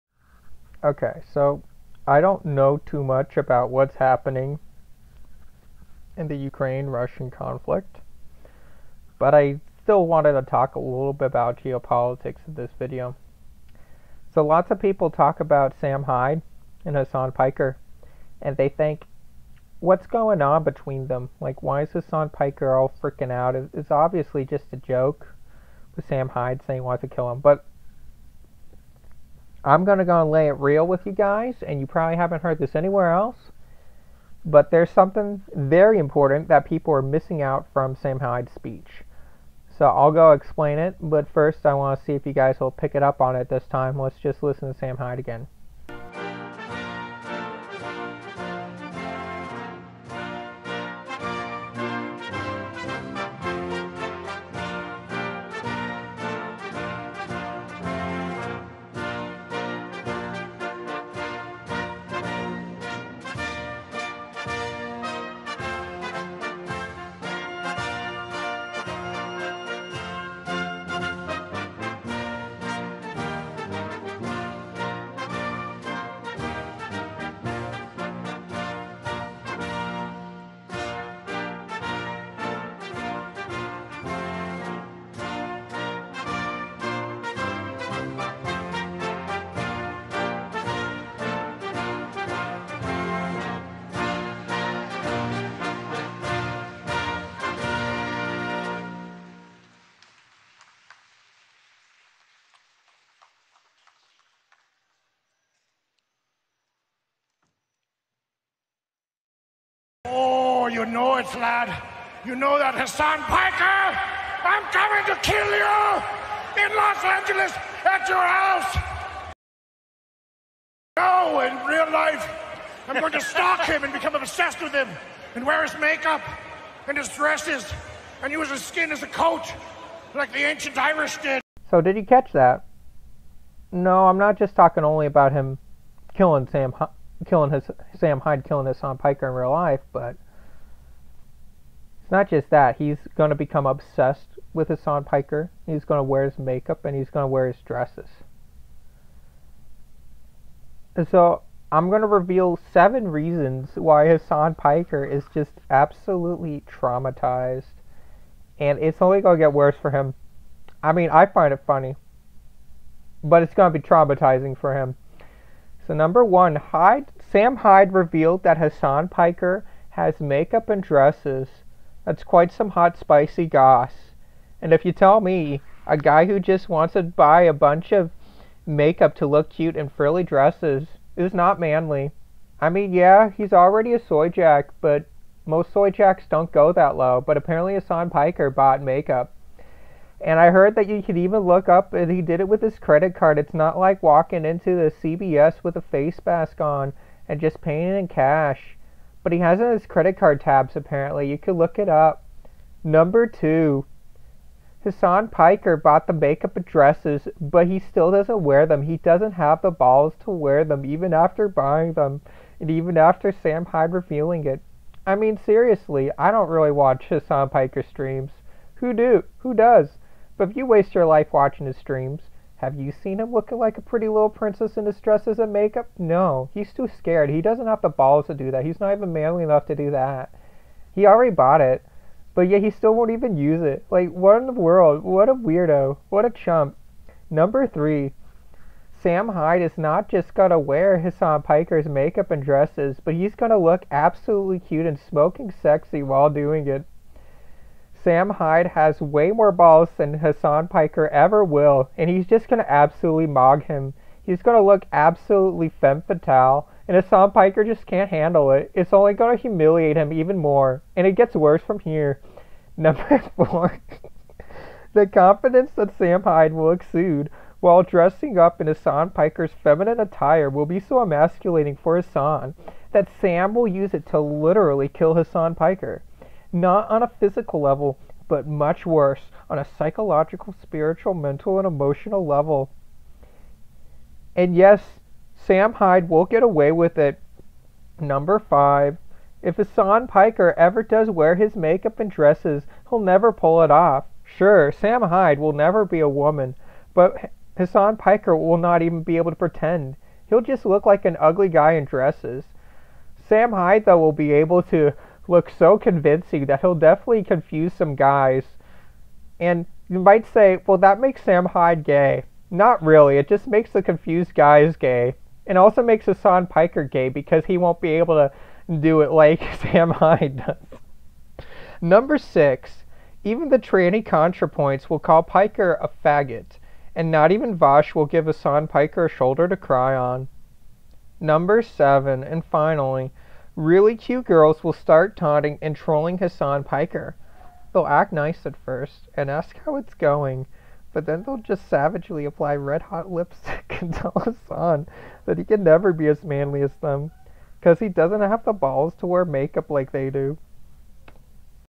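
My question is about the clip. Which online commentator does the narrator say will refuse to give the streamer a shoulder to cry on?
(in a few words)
Vaush.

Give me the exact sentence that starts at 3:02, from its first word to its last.
I mean, yeah, he's already a soy jack, but most soy jacks don't go that low.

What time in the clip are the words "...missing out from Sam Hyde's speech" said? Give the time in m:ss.
0:37.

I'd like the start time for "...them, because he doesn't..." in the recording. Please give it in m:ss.
5:46.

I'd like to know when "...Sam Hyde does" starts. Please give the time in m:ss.
5:19.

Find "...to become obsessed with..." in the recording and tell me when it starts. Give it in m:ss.
2:23.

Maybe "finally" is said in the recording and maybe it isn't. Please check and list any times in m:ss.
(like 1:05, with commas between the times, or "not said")
5:32.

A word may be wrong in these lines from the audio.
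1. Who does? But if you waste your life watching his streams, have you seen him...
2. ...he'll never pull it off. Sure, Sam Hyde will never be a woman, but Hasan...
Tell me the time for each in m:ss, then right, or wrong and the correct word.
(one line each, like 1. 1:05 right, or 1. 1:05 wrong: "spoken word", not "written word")
1. 3:39 right
2. 4:52 right.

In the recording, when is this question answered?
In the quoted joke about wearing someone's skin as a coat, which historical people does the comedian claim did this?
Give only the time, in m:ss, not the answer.
2:10.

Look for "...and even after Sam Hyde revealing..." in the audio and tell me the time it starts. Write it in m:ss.
3:32.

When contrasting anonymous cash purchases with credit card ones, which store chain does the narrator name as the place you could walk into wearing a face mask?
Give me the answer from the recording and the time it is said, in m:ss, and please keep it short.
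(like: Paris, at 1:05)
CVS, at 3:15.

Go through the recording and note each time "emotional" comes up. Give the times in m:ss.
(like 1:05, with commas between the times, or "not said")
4:41.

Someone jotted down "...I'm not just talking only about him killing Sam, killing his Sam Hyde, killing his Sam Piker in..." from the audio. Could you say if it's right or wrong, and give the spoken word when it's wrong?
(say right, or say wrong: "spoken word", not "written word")
right.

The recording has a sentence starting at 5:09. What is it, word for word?
And you might say, well, that makes Sam Hyde gay.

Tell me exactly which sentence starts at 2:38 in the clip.
And it's only going to get worse for him.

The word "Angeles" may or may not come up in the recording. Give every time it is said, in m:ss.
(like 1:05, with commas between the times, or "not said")
1:57.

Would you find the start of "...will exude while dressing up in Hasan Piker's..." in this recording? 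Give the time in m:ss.
4:26.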